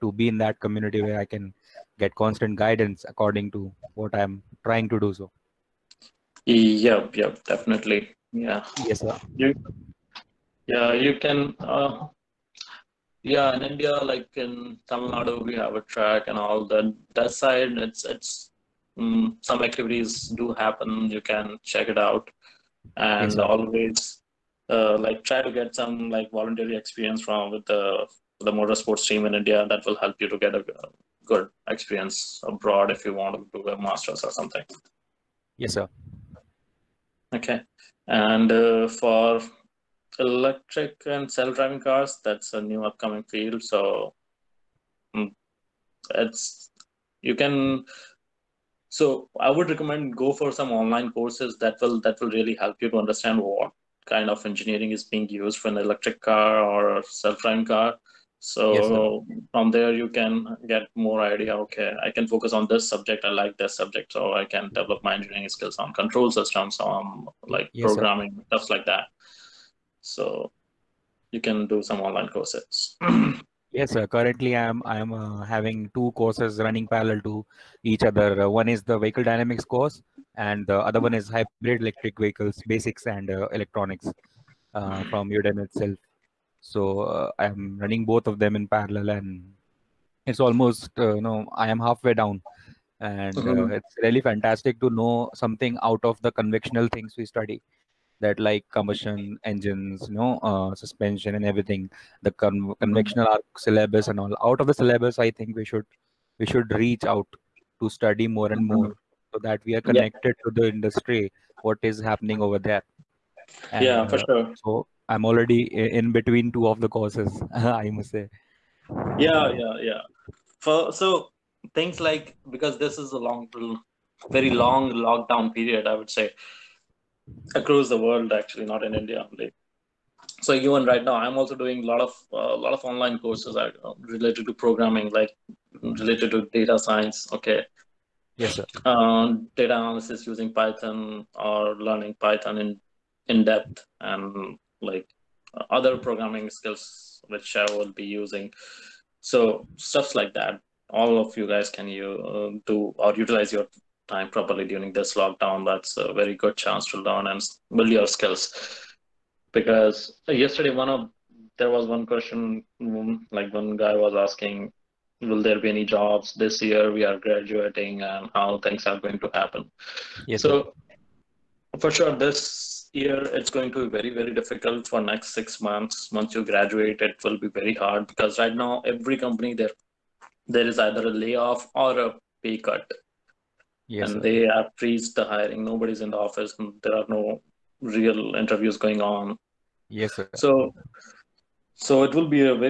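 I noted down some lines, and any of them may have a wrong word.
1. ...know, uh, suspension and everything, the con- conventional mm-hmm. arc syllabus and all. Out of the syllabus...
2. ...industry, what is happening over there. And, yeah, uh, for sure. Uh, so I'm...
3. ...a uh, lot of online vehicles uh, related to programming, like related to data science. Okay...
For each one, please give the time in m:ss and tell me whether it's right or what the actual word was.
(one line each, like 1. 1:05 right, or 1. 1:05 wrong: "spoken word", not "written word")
1. 1:40 right
2. 1:50 right
3. 2:12 wrong: "courses", not "vehicles".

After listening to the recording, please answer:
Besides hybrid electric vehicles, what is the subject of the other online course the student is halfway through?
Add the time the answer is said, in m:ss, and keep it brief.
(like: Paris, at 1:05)
vehicle dynamics, at 1:18.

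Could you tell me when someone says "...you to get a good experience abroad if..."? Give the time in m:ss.
0:30.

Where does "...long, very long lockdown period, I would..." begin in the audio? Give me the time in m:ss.
2:03.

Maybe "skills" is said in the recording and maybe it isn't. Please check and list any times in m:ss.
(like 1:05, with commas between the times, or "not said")
1:05, 2:26, 2:38.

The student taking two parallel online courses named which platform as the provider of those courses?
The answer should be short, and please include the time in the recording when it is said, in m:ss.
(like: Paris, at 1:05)
Udemy, at 1:25.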